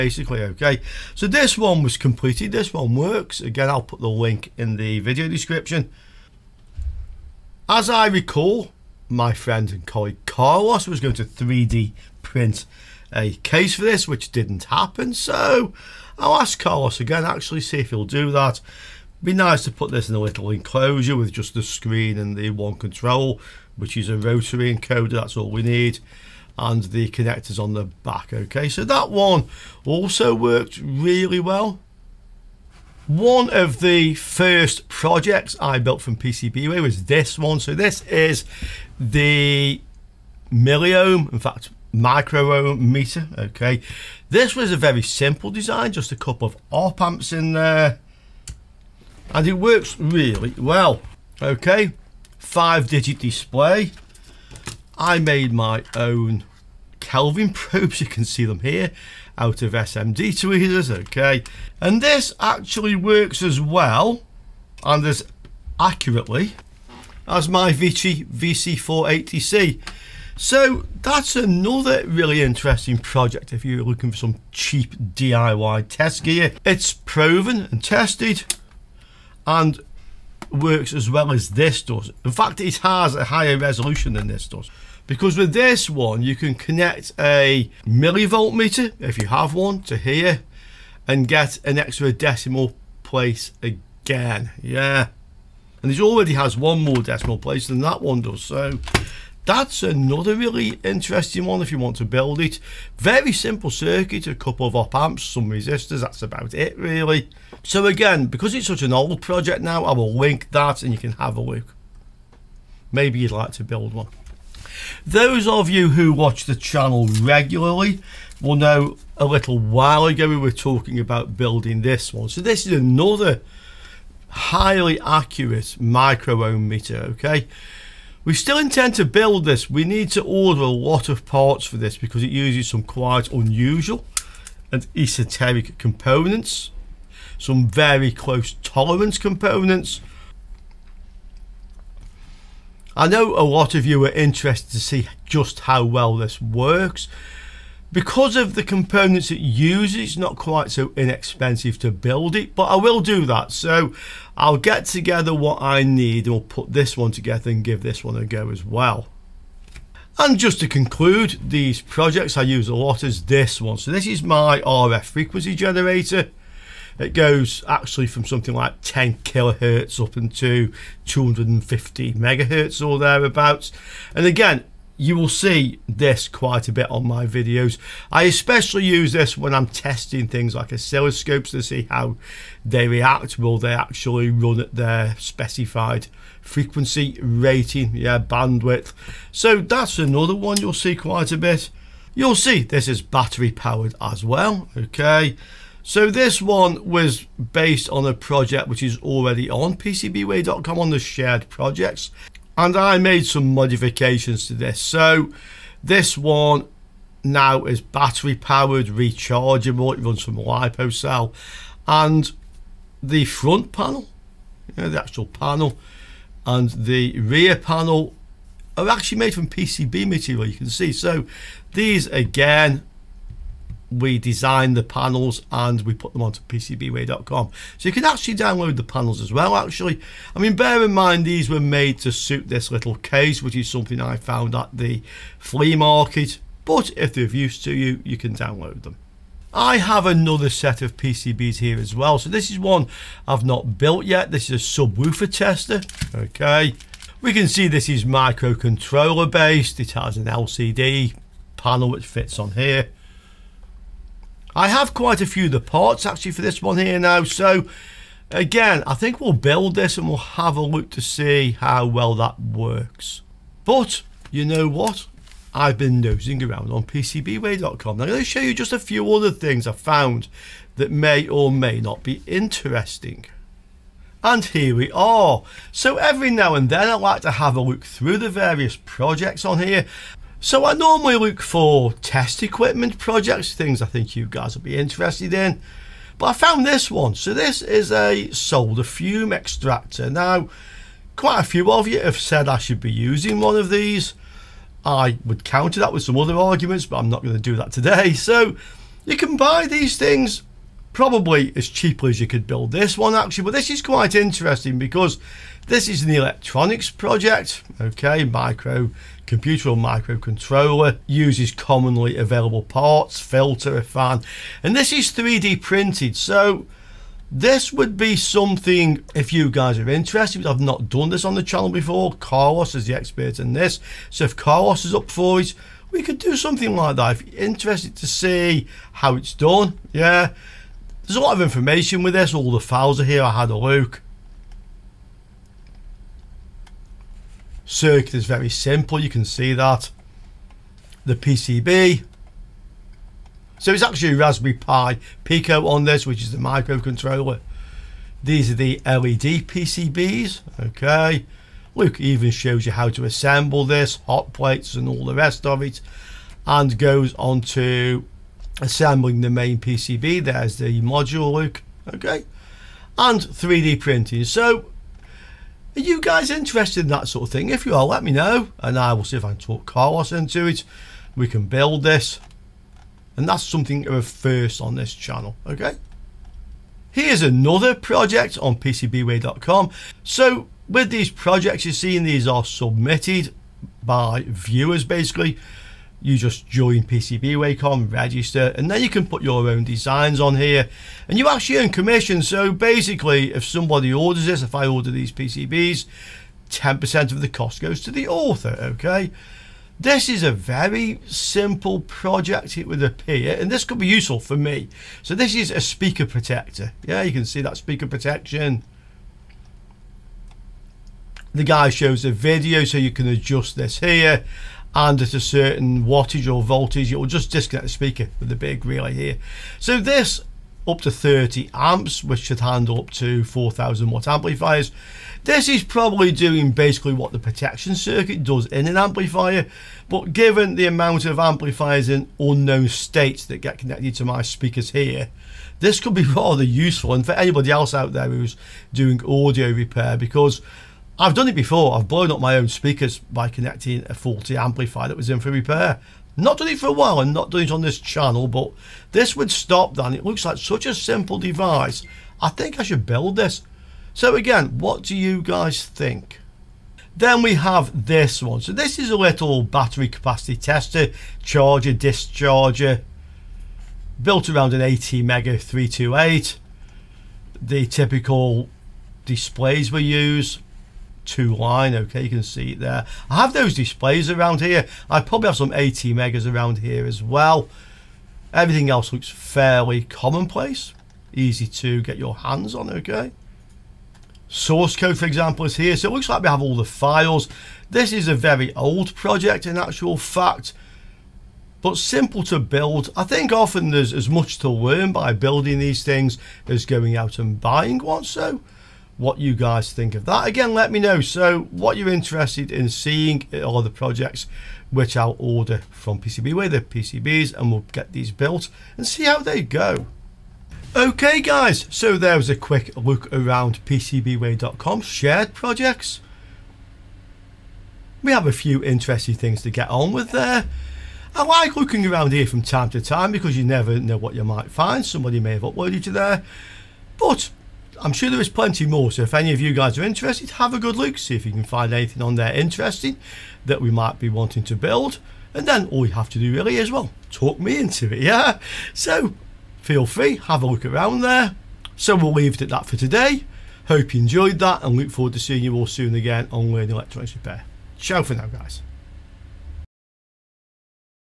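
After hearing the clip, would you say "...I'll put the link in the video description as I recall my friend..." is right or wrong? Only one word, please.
right.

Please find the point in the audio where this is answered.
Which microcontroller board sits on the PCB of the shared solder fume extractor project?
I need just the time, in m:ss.
5:44.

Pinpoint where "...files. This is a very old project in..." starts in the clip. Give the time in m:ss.
8:06.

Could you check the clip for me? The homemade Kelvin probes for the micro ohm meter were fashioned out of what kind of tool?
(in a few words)
SMD tweezers.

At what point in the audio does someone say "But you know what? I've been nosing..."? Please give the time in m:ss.
4:23.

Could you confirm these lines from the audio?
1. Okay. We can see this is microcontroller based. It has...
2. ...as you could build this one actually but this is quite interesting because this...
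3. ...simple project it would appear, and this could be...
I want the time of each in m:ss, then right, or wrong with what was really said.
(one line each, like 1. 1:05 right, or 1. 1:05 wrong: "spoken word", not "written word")
1. 4:06 right
2. 5:02 right
3. 6:41 right.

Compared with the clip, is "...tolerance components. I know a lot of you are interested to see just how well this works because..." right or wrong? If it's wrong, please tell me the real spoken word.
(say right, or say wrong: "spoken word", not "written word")
right.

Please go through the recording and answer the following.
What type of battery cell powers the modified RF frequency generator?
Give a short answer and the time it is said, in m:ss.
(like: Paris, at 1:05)
lipo cell, at 3:30.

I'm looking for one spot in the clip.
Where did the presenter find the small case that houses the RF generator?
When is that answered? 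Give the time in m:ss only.
3:55.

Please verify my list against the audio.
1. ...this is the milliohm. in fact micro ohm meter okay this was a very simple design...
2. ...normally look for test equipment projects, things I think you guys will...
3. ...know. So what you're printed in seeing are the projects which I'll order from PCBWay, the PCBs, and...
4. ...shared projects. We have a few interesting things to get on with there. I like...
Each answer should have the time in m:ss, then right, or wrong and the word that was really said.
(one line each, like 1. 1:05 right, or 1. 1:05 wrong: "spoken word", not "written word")
1. 0:37 right
2. 4:40 right
3. 8:20 wrong: "interested", not "printed"
4. 8:34 right.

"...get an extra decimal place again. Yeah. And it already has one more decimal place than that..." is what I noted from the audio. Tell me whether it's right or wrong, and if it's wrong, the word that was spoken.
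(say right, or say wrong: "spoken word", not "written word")
right.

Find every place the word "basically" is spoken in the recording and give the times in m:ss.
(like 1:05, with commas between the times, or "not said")
6:24, 6:32, 7:06.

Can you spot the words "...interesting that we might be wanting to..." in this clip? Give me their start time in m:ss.
8:52.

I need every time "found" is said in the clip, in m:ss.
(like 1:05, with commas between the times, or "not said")
3:54, 4:29, 4:46.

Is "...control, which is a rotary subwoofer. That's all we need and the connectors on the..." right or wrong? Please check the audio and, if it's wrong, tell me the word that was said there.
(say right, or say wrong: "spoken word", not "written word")
wrong: "encoder", not "subwoofer".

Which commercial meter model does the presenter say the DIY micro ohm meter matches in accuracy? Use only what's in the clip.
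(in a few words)
VC480C.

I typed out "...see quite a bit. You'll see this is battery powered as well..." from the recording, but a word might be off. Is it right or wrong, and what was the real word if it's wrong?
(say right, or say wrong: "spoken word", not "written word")
right.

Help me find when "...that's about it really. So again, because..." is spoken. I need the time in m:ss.
1:46.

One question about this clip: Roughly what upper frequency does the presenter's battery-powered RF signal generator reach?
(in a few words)
250 megahertz.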